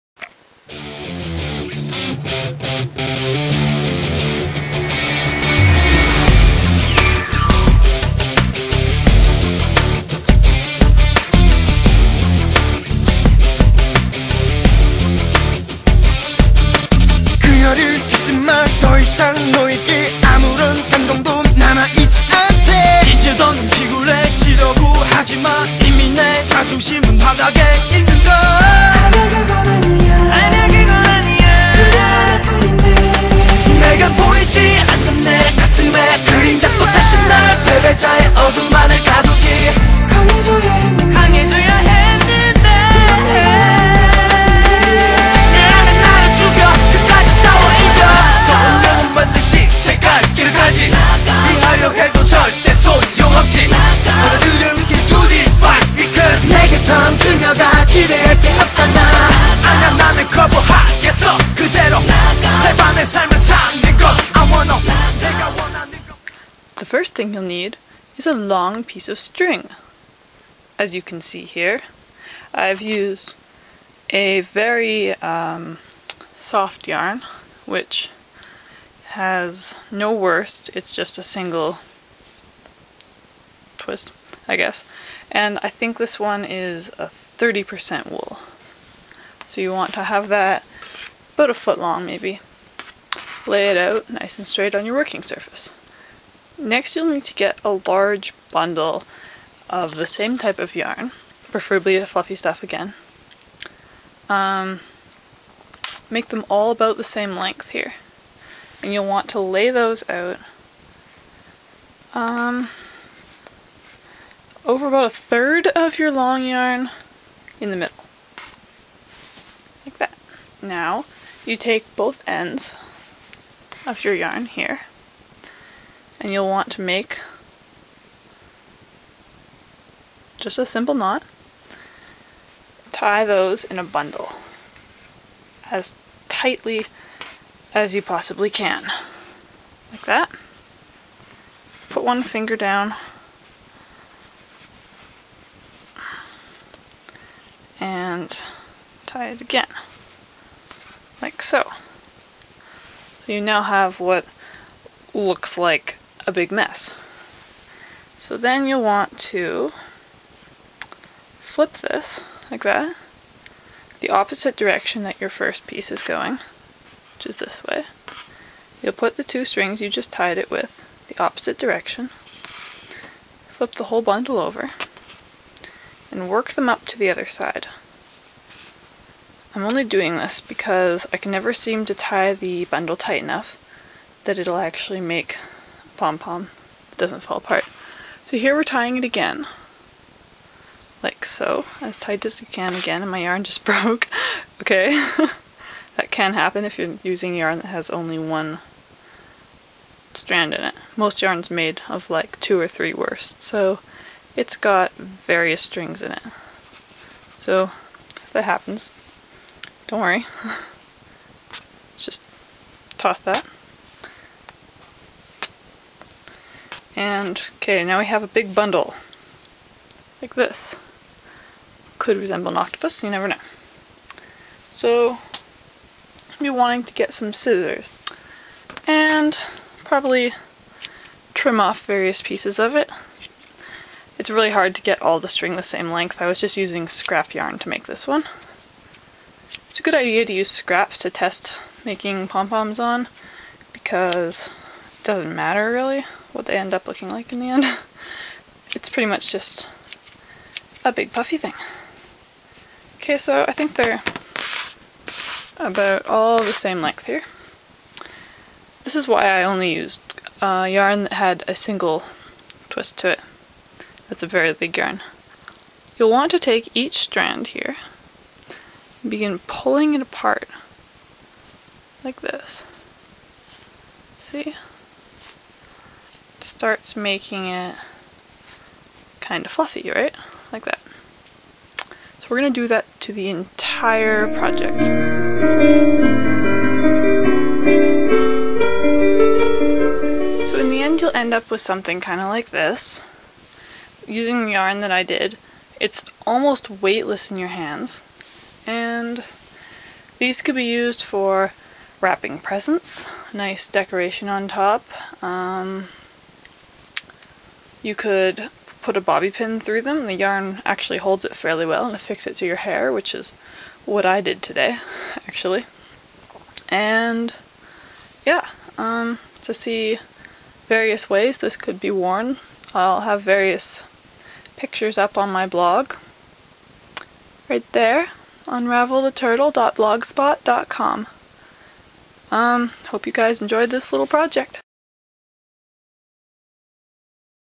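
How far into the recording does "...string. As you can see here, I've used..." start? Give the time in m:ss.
1:09.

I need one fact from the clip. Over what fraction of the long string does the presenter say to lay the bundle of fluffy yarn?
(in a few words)
a third.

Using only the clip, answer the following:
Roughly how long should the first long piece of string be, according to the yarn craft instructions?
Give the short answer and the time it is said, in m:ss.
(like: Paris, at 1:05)
a foot, at 1:31.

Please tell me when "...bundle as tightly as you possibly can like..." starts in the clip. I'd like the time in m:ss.
2:13.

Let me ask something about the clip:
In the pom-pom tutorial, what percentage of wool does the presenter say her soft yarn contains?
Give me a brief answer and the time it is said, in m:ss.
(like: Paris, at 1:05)
30%, at 1:27.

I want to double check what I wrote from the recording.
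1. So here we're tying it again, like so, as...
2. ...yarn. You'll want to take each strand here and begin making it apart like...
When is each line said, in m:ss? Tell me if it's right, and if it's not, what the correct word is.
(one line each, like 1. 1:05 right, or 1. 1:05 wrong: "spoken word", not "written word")
1. 3:08 right
2. 4:24 wrong: "pulling", not "making".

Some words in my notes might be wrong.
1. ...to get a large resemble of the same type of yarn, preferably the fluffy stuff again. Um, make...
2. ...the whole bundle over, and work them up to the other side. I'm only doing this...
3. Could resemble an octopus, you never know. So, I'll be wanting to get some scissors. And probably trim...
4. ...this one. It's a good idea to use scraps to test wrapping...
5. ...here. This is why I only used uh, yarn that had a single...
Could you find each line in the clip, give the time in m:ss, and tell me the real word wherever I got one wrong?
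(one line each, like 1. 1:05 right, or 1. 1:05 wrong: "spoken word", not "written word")
1. 1:37 wrong: "bundle", not "resemble"
2. 2:53 right
3. 3:41 right
4. 3:57 wrong: "making", not "wrapping"
5. 4:17 right.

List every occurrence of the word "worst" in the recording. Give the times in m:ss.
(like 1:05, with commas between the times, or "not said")
1:20, 3:22.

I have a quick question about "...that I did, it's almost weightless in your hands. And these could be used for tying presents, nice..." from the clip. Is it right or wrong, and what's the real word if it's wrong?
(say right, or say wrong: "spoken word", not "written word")
wrong: "wrapping", not "tying".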